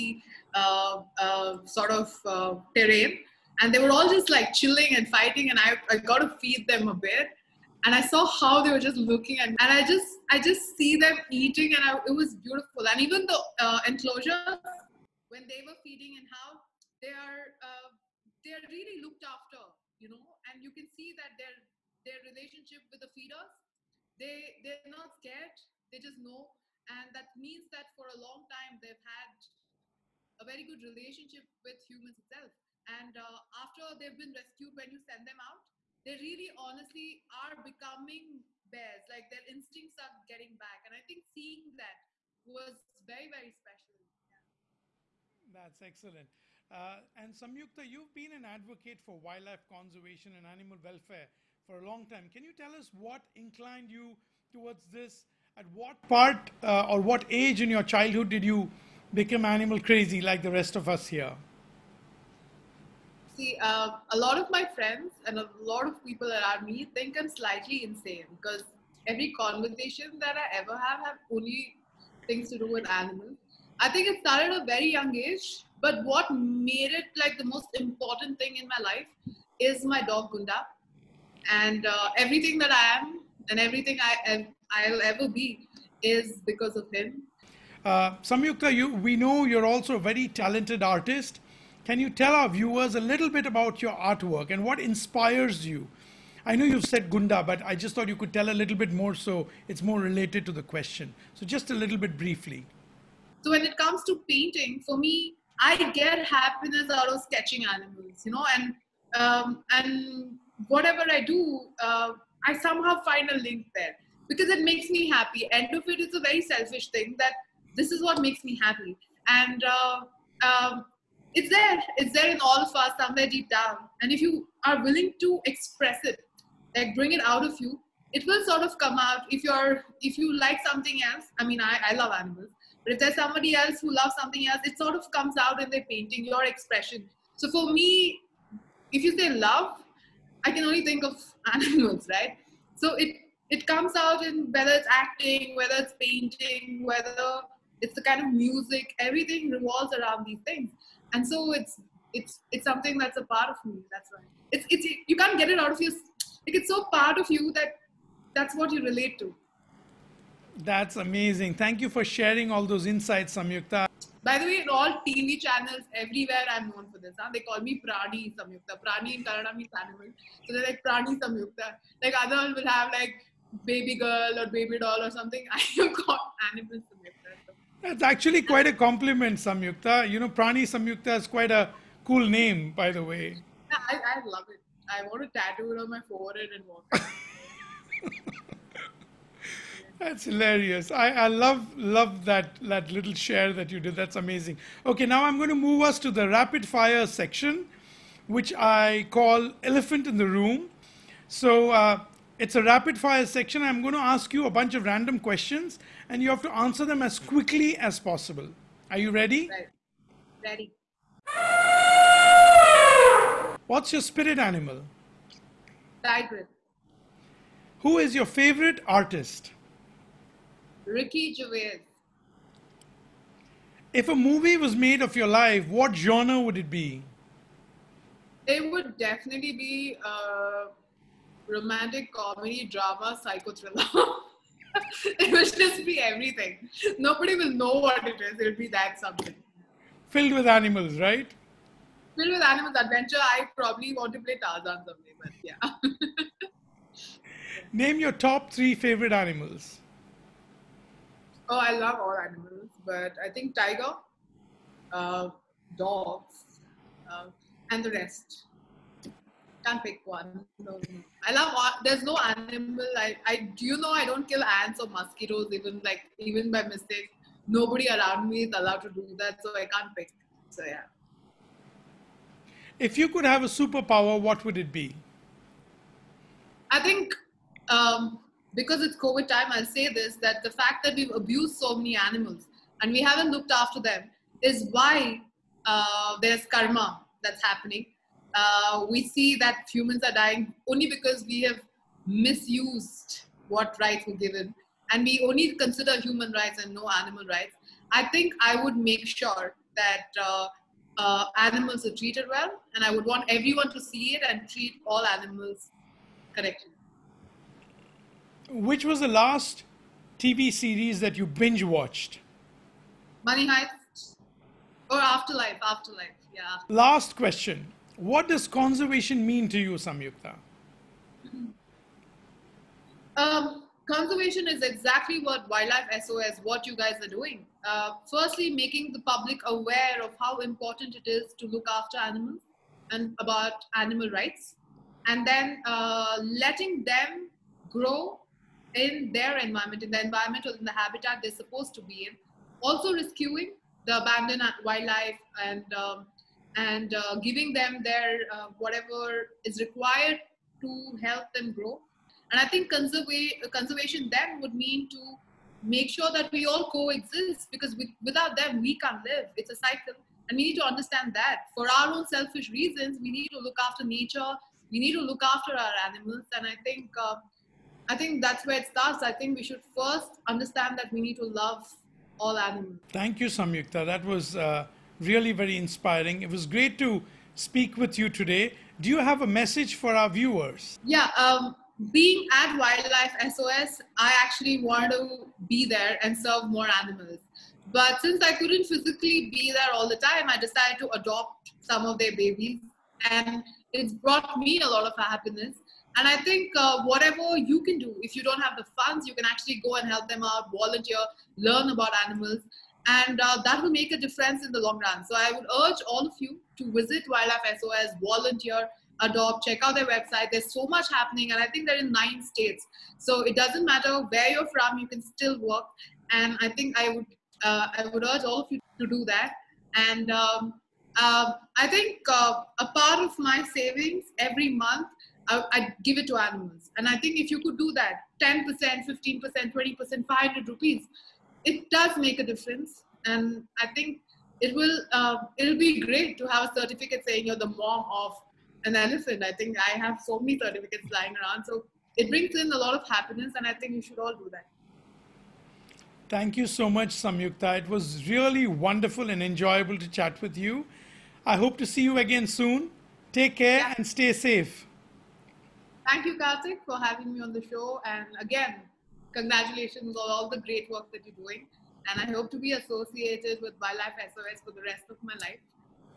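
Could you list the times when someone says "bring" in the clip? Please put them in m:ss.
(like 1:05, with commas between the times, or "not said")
2:06, 7:22.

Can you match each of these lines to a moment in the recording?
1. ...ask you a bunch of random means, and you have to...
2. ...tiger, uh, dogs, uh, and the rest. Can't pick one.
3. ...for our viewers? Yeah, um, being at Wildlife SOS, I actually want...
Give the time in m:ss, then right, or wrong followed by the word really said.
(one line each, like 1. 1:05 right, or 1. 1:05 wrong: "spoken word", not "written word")
1. 3:24 wrong: "questions", not "means"
2. 4:13 right
3. 6:19 right.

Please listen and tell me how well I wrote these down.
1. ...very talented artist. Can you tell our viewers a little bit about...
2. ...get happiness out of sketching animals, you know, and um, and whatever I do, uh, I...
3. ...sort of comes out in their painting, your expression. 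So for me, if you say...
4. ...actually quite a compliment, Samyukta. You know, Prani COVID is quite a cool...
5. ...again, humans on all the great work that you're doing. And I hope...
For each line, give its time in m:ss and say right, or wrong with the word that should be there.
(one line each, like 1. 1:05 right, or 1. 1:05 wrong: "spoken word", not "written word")
1. 1:29 right
2. 1:45 right
3. 2:14 right
4. 2:58 wrong: "Samyukta", not "COVID"
5. 7:38 wrong: "congratulations", not "humans".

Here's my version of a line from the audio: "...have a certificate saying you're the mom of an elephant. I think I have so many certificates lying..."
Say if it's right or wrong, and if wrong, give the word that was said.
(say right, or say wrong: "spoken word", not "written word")
right.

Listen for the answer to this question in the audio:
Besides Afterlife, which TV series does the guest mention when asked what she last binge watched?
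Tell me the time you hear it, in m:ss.
5:13.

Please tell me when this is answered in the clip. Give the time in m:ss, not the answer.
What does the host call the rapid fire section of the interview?
3:19.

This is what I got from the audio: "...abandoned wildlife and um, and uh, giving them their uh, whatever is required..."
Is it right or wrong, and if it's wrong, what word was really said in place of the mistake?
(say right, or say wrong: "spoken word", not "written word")
right.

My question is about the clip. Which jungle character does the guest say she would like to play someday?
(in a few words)
Tarzan.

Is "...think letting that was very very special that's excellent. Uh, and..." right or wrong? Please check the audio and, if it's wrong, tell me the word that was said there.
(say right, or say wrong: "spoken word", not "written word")
wrong: "seeing", not "letting".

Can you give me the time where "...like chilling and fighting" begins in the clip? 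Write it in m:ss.
0:04.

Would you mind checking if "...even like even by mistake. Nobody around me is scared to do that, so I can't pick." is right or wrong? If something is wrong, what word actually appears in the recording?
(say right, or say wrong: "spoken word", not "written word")
wrong: "allowed", not "scared".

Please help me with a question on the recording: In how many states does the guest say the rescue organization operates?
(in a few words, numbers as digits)
9.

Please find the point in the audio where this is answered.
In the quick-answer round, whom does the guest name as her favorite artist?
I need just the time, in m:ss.
3:40.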